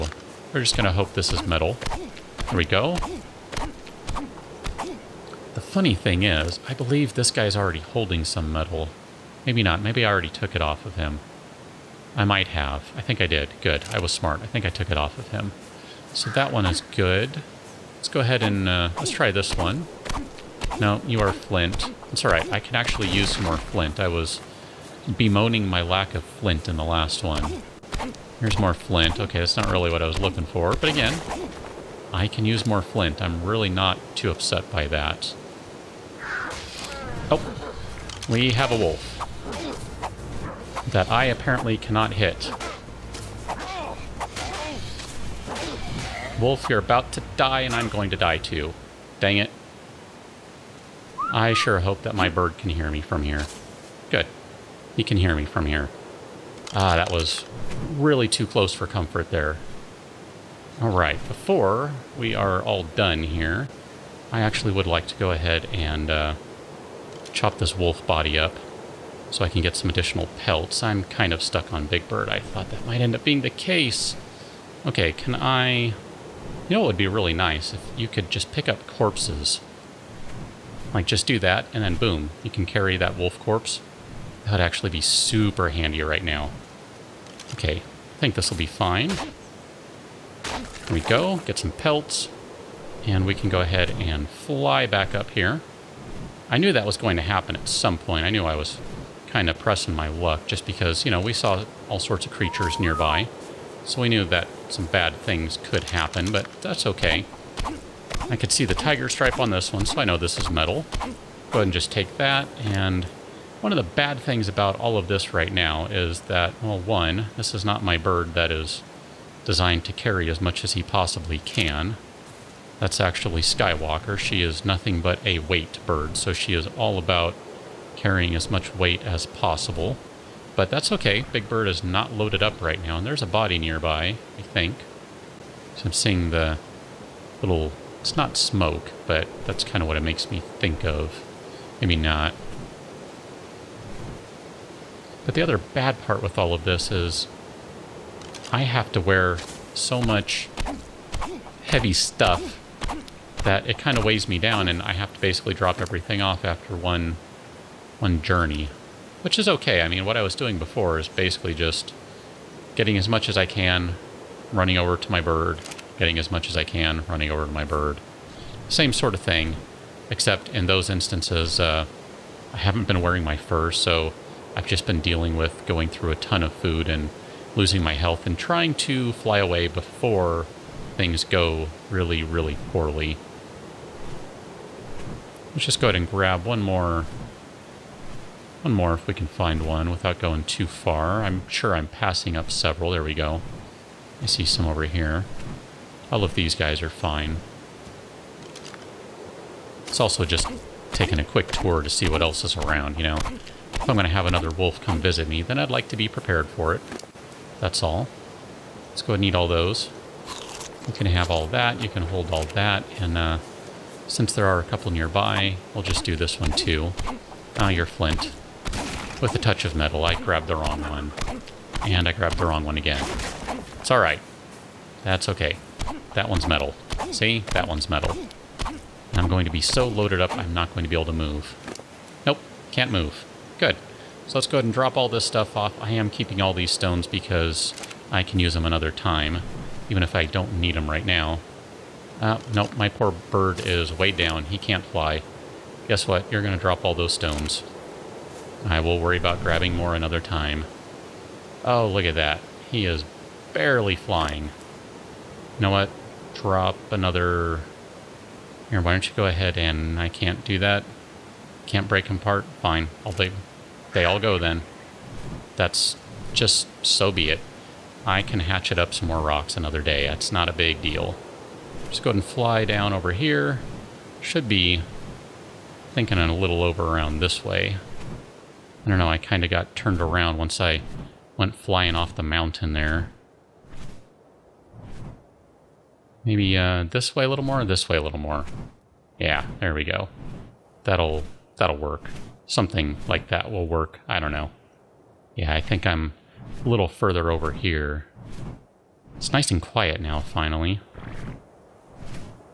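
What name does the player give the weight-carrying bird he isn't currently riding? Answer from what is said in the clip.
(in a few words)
Skywalker.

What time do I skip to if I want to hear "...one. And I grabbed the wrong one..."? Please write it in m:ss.
3:40.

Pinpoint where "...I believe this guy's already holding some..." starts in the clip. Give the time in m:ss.
0:06.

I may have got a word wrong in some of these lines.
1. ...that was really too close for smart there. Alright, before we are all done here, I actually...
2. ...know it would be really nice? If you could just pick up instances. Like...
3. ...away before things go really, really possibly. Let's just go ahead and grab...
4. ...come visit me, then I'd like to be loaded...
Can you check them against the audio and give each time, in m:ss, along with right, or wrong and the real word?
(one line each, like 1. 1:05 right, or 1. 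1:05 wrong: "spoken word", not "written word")
1. 0:56 wrong: "comfort", not "smart"
2. 1:16 wrong: "corpses", not "instances"
3. 2:59 wrong: "poorly", not "possibly"
4. 3:24 wrong: "prepared", not "loaded".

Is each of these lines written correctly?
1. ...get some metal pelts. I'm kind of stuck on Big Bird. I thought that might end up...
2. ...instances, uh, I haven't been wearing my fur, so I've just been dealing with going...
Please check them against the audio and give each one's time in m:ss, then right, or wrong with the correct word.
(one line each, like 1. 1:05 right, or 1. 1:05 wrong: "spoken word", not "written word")
1. 1:09 wrong: "additional", not "metal"
2. 2:50 right.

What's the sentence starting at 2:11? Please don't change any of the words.
Big Bird is not loaded up right now, and there's a body nearby, I think.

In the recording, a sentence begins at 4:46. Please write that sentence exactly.
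Maybe uh, this way a little more, this way a little more.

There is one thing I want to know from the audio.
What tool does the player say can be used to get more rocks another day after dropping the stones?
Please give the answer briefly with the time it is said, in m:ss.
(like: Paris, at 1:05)
Hatchet, at 4:28.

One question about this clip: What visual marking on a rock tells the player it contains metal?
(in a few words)
Tiger stripe.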